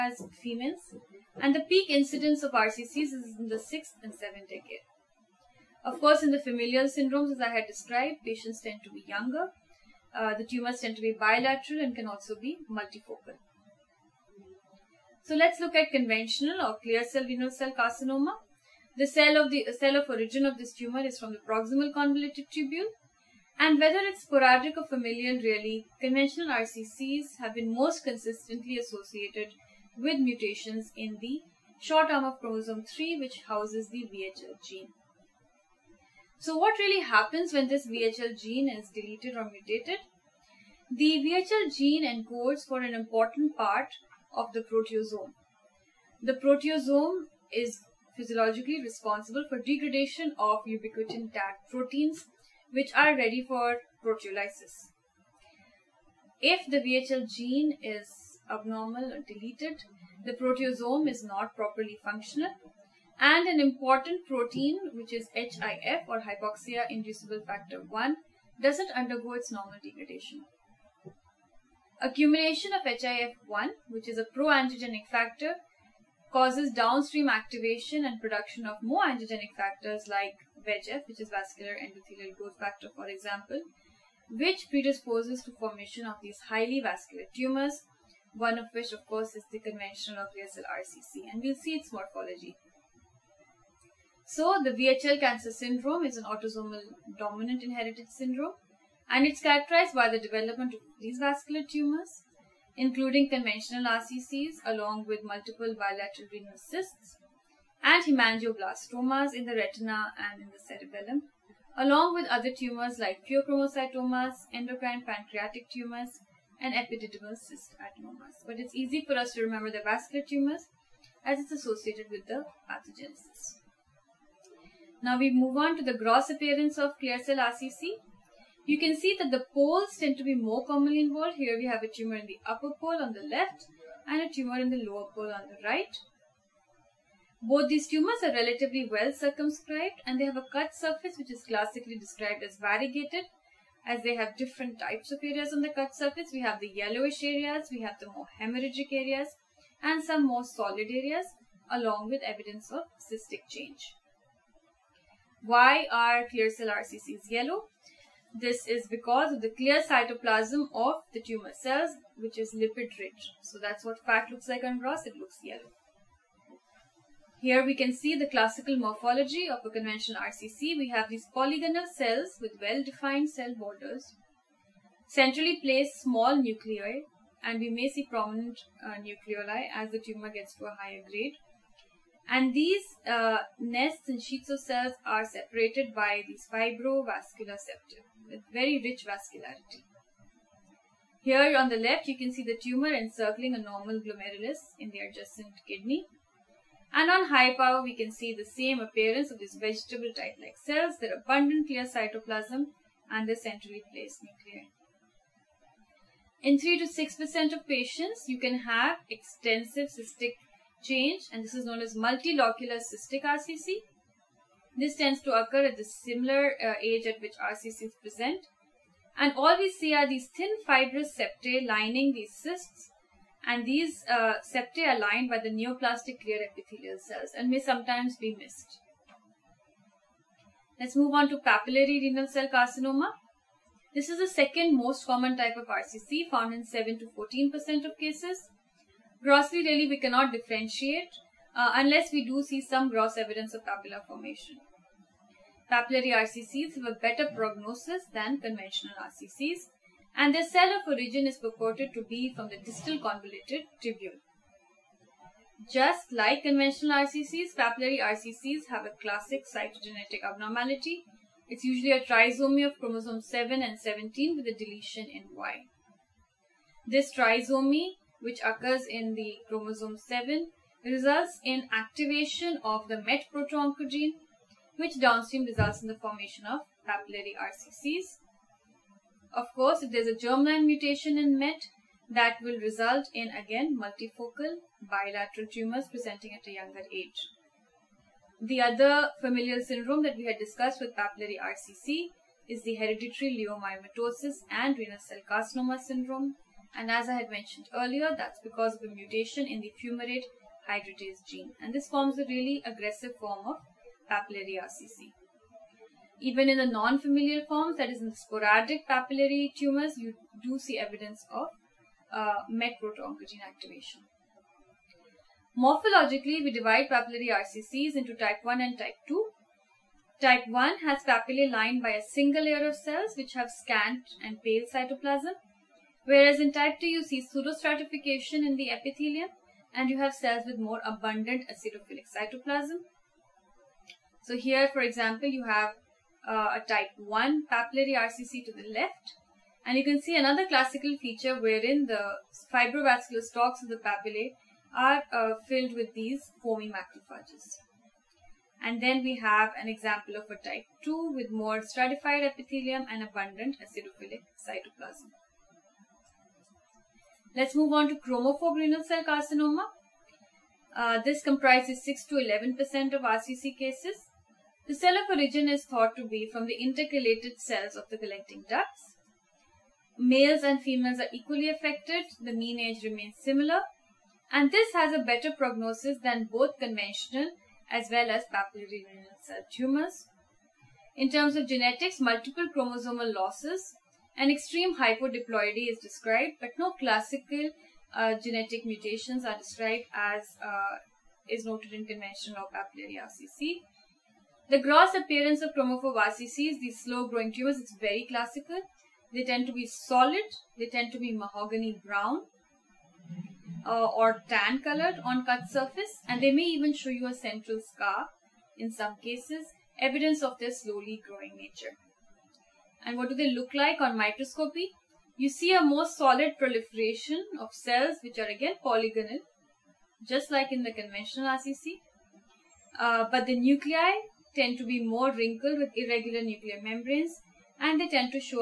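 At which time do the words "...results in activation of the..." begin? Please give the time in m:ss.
4:30.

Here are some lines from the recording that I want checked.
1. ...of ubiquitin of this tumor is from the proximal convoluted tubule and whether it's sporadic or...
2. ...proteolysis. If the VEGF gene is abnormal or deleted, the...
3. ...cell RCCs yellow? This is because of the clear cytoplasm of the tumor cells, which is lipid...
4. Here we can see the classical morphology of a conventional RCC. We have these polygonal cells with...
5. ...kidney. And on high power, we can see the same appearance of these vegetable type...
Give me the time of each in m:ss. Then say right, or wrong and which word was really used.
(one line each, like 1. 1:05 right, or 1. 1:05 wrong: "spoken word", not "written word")
1. 0:19 wrong: "origin", not "ubiquitin"
2. 0:54 wrong: "VHL", not "VEGF"
3. 2:36 right
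4. 2:47 right
5. 3:15 right.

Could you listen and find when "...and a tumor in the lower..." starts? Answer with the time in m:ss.
2:14.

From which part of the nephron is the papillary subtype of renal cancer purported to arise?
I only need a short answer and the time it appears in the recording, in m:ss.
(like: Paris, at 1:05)
distal convoluted tubule, at 4:12.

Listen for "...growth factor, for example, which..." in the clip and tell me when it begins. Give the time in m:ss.
1:22.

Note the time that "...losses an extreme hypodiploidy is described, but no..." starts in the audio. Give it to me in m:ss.
6:23.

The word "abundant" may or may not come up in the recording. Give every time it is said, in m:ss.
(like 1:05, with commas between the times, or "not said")
3:21, 5:30, 5:53.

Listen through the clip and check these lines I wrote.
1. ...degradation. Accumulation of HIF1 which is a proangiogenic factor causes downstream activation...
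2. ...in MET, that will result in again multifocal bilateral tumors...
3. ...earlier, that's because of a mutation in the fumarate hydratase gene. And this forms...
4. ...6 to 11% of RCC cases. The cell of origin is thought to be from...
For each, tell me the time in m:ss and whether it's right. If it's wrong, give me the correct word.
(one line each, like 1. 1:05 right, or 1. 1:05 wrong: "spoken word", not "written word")
1. 1:09 right
2. 4:41 right
3. 4:57 right
4. 6:01 right.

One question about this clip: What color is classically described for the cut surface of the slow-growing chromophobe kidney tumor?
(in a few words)
mahogany brown.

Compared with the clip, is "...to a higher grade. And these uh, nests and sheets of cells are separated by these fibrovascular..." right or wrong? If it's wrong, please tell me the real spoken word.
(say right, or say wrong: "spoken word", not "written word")
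right.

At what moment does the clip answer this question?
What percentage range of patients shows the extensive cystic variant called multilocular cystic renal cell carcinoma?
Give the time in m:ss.
3:26.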